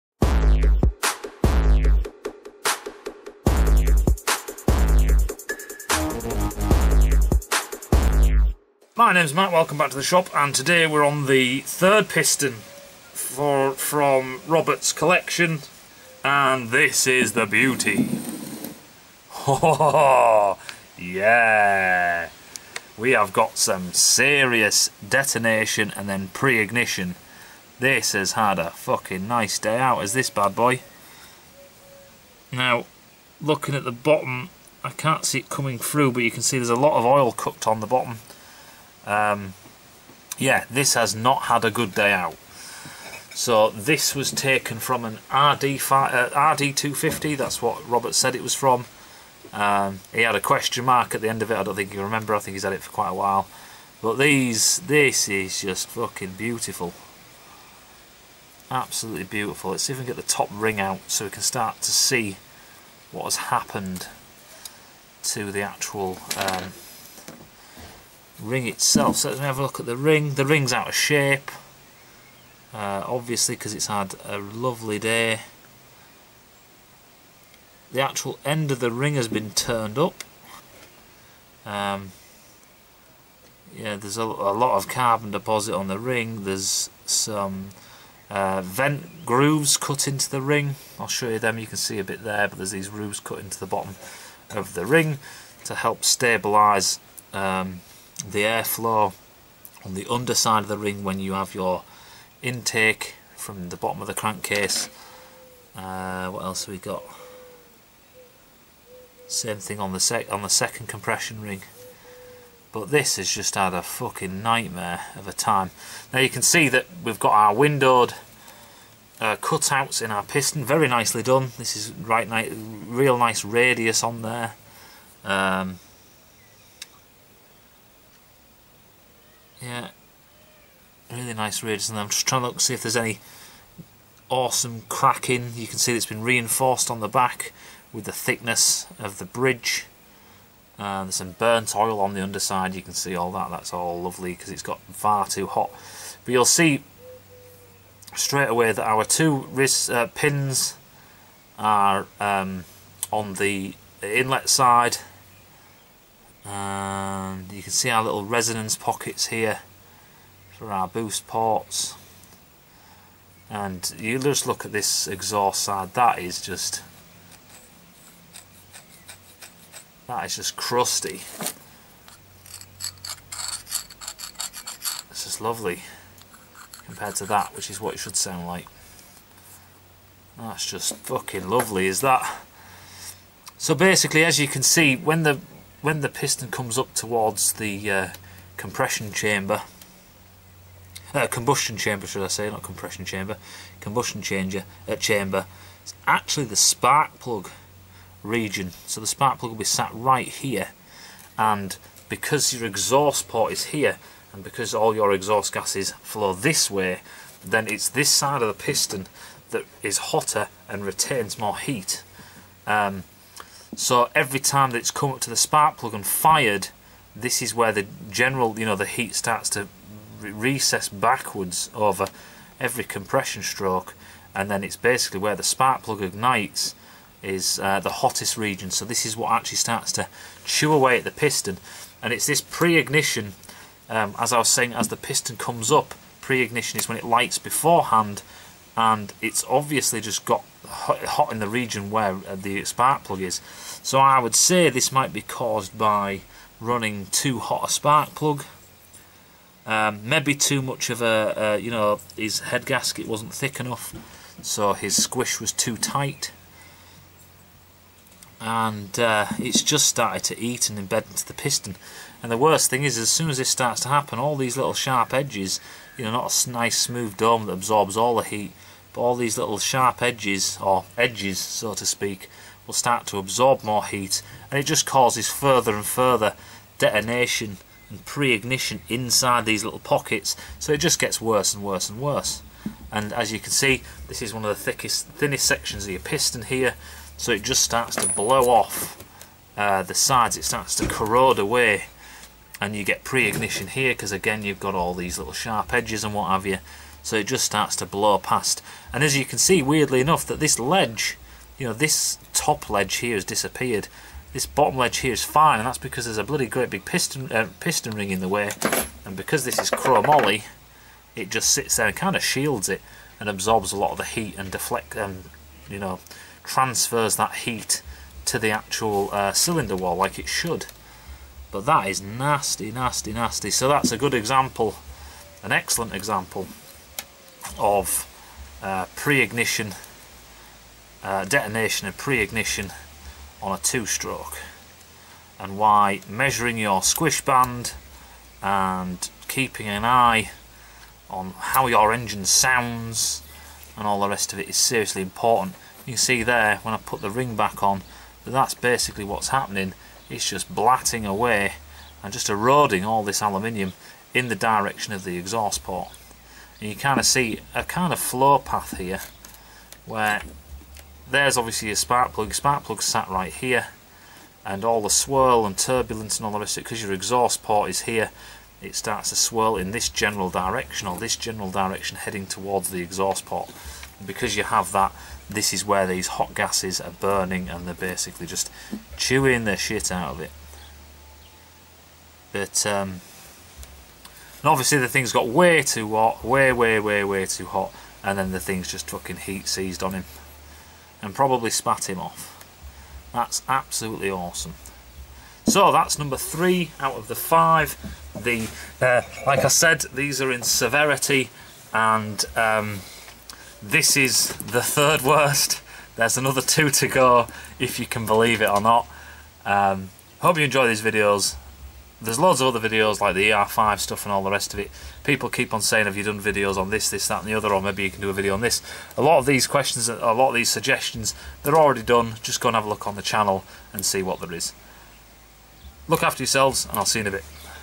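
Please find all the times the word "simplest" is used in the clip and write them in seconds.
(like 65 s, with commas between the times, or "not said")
not said.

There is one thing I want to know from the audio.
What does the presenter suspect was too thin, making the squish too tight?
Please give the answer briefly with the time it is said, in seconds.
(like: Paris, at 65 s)
head gasket, at 252 s.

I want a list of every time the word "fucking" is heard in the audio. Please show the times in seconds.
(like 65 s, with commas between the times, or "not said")
28 s, 55 s, 113 s, 180 s, 388 s.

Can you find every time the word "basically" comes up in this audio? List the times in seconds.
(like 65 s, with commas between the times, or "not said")
183 s, 224 s, 348 s, 377 s.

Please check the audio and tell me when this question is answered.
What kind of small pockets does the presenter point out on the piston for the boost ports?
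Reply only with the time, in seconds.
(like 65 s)
158 s.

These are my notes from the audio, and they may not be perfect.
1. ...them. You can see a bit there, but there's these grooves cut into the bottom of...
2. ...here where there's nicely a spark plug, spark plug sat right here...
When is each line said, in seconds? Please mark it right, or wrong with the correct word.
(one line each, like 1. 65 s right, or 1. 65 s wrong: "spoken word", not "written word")
1. 91 s right
2. 358 s wrong: "obviously", not "nicely".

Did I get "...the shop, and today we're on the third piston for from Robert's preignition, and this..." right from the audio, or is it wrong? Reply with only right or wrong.
wrong.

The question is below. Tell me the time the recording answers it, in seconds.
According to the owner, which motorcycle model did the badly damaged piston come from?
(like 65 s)
46 s.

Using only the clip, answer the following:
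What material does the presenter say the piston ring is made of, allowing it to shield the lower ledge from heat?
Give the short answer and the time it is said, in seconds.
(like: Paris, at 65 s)
chromoly, at 309 s.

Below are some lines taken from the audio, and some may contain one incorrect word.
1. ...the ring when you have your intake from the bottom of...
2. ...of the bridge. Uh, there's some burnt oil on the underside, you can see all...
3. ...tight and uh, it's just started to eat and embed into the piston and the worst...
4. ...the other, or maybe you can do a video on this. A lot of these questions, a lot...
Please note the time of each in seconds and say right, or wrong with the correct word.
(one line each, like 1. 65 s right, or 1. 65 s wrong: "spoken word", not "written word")
1. 100 s right
2. 138 s right
3. 255 s right
4. 417 s right.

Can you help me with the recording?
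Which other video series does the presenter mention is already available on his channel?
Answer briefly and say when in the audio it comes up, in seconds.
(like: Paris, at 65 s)
ER5, at 413 s.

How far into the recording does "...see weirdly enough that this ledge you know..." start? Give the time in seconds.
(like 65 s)
299 s.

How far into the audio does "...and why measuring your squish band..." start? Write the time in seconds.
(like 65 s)
335 s.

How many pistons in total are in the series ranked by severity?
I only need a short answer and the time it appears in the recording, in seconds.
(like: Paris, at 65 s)
5, at 397 s.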